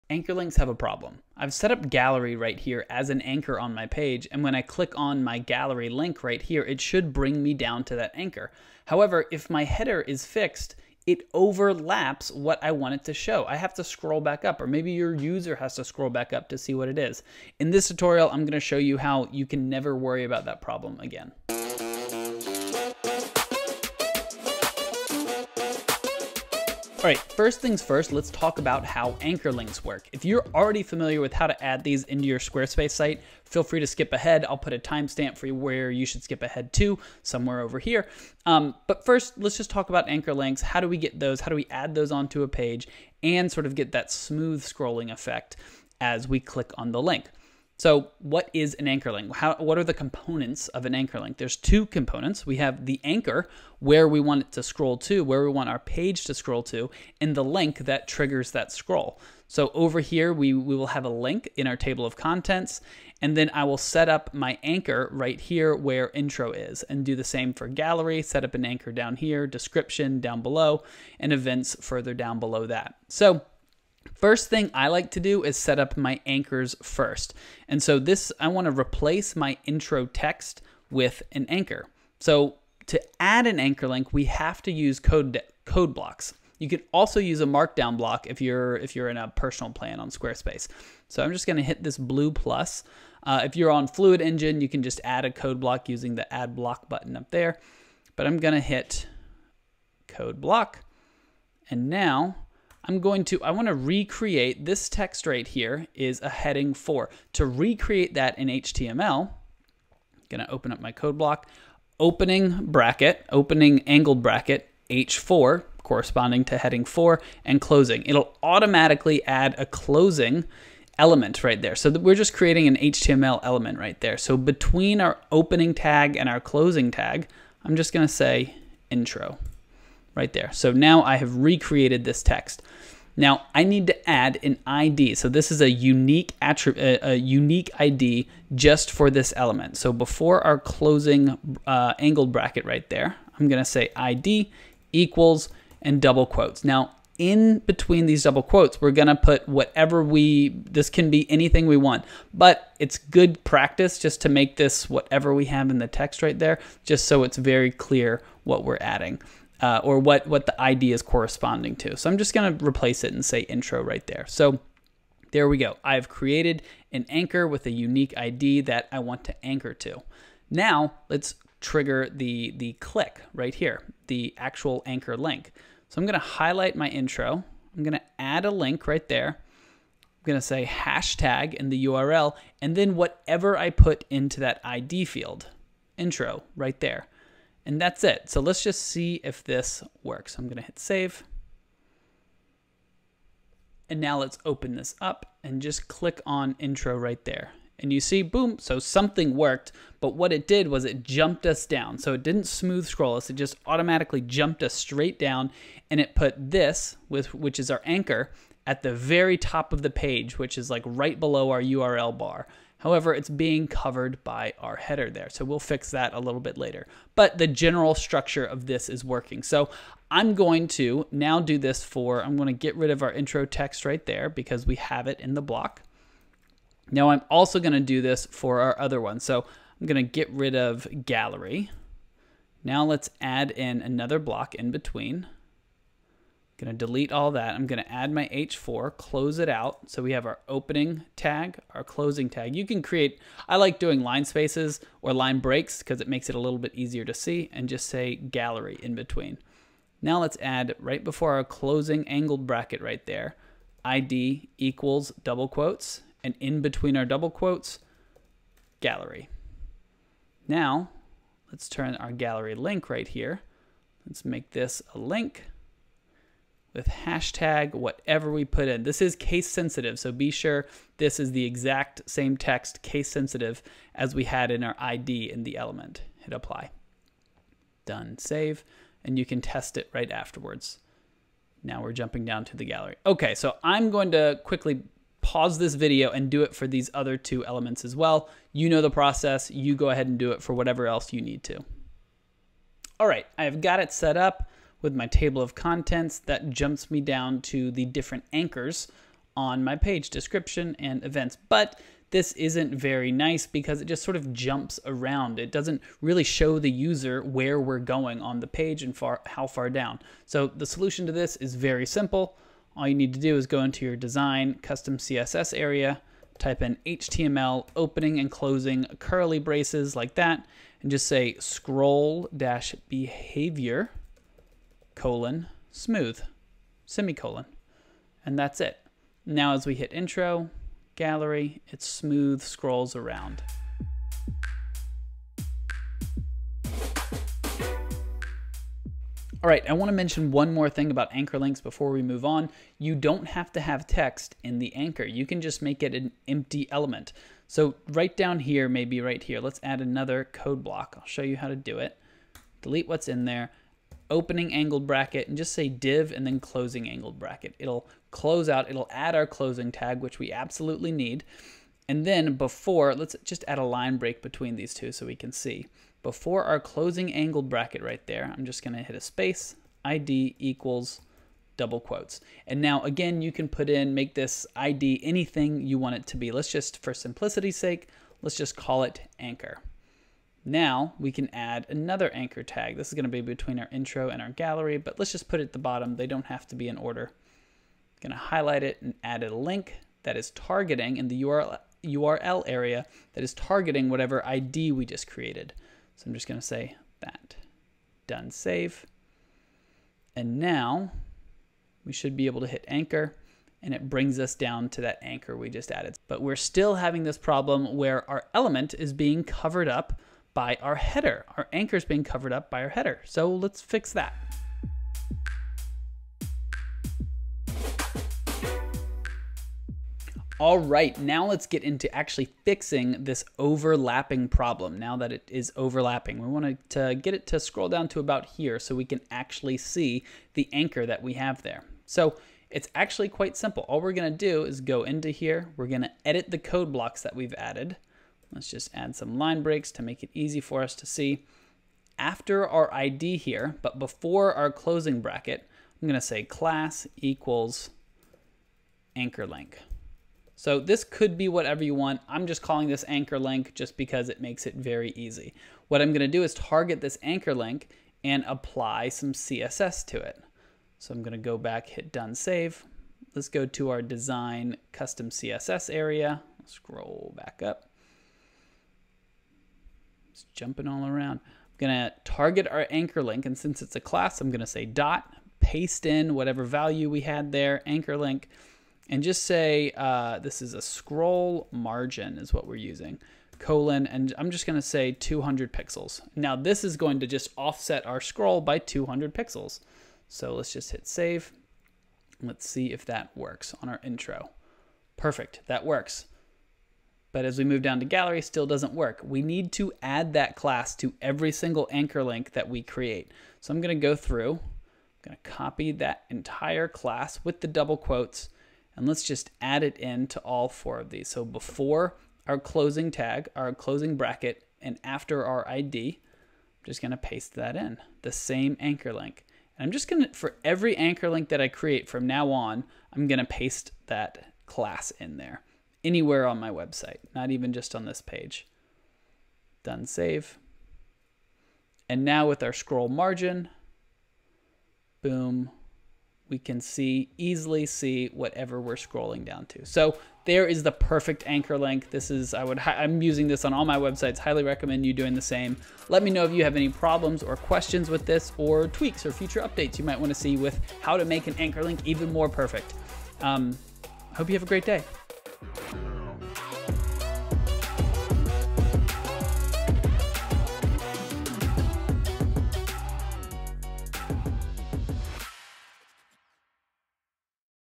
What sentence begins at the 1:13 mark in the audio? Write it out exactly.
So, First thing I like to do is set up my anchors first.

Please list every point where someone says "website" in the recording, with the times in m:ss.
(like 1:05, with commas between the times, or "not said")
8:46, 9:03.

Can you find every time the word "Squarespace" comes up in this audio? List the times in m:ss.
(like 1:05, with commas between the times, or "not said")
0:32, 1:30.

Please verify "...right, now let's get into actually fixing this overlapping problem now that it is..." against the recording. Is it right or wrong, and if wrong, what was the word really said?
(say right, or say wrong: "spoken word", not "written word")
right.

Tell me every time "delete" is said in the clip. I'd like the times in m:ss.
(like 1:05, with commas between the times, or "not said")
3:56, 5:52.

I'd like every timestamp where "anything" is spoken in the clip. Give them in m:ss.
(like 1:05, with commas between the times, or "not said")
2:31, 6:15.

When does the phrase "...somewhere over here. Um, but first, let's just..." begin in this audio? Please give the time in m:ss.
0:37.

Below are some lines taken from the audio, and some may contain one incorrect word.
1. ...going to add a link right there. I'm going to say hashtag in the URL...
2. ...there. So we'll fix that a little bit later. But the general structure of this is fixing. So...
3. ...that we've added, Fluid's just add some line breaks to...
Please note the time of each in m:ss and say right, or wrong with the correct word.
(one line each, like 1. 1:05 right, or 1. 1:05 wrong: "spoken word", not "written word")
1. 2:57 right
2. 3:35 wrong: "working", not "fixing"
3. 7:17 wrong: "Let", not "Fluid".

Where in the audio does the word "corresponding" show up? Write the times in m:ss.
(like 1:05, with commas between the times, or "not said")
1:55, 2:41.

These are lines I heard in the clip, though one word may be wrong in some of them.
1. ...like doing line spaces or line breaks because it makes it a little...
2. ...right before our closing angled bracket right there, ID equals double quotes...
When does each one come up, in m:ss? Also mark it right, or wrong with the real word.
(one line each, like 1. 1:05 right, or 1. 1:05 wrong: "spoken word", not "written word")
1. 4:03 right
2. 4:10 right.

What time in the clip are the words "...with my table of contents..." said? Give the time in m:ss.
4:54.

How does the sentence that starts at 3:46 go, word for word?
Now I'm also going to do this for our other one.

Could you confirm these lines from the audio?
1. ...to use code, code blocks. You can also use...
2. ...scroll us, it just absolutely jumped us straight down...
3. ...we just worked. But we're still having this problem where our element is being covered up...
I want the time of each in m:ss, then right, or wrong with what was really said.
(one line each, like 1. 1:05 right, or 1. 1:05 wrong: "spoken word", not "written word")
1. 1:24 right
2. 3:22 wrong: "automatically", not "absolutely"
3. 6:45 wrong: "added", not "worked".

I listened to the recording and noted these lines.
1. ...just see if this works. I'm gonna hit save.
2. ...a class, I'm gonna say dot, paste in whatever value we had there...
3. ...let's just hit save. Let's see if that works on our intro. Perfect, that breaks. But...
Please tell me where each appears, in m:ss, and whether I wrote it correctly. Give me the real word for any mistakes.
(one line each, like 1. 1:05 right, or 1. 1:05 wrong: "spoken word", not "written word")
1. 3:08 right
2. 7:53 right
3. 8:10 wrong: "works", not "breaks".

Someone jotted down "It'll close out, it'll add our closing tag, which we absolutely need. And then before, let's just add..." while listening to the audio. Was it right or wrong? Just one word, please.
right.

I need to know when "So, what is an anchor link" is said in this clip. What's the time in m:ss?
0:47.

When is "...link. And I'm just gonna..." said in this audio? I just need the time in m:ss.
8:38.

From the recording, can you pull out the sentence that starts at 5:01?
But this isn't very nice because it just sort of jumps around.